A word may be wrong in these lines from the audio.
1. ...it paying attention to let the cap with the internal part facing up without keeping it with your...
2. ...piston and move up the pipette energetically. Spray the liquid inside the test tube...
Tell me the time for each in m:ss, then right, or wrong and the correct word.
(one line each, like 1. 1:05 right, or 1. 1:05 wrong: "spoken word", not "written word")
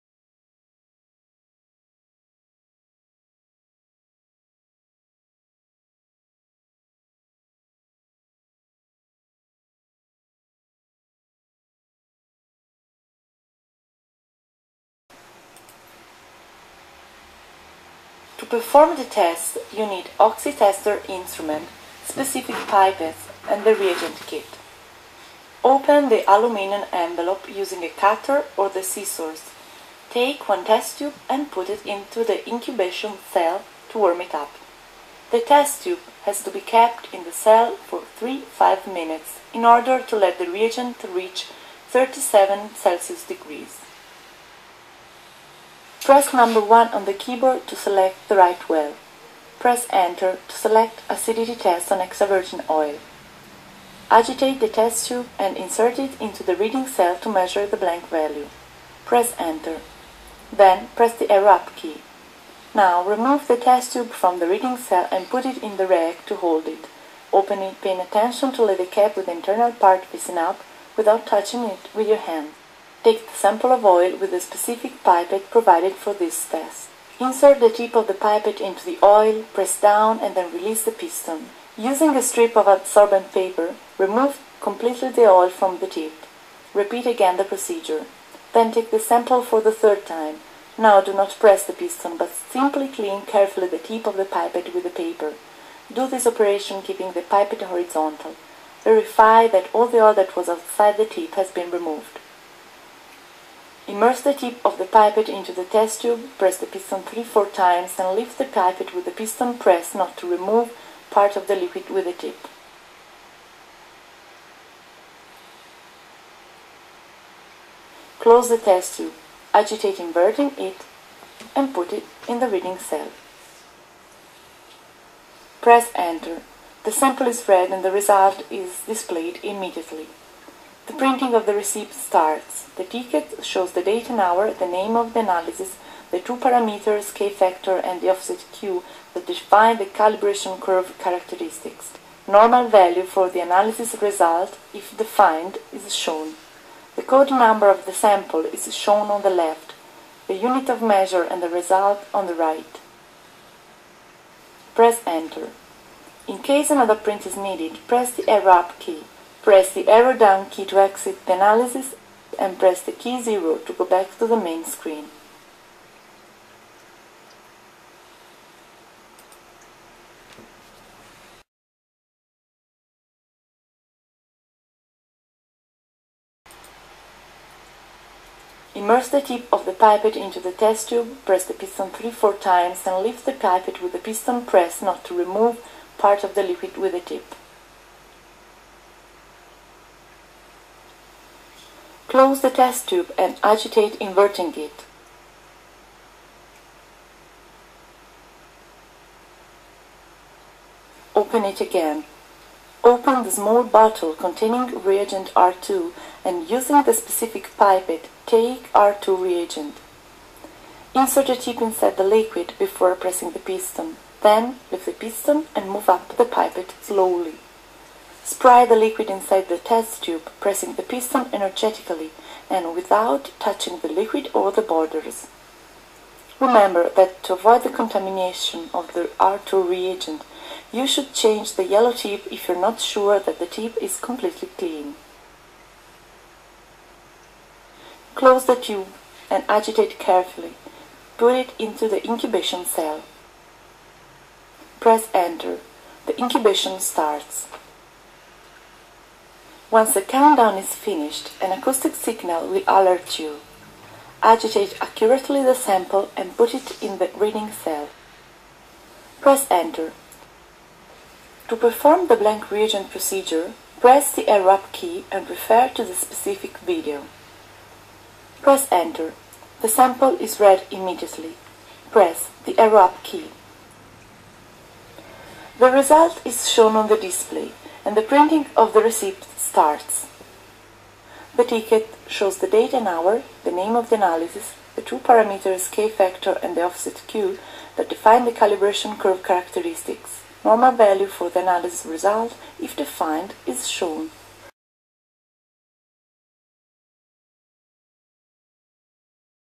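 1. 1:07 wrong: "touching", not "keeping"
2. 3:34 wrong: "slowly", not "energetically".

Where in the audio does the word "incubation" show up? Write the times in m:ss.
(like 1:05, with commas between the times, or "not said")
0:32, 4:02, 4:06.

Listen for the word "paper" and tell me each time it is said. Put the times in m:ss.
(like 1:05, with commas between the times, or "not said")
1:23, 1:34.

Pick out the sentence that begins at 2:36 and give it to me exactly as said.
In case another print is needed, press the Arrow up key.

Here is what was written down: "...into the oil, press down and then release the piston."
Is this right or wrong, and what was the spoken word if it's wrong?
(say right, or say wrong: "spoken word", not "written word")
right.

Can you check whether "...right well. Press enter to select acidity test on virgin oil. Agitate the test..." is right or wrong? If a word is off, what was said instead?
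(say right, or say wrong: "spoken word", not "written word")
right.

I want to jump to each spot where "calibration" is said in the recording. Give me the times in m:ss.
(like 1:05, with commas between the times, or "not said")
2:19, 4:48.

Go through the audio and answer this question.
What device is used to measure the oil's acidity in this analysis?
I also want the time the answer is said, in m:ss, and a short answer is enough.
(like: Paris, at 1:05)
OxiTester, at 0:20.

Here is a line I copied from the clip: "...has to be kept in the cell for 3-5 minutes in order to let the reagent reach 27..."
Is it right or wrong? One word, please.
wrong.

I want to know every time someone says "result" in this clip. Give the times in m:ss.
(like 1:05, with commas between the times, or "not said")
2:07, 2:24, 2:31, 4:35, 4:51.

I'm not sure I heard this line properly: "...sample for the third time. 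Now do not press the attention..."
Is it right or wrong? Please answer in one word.
wrong.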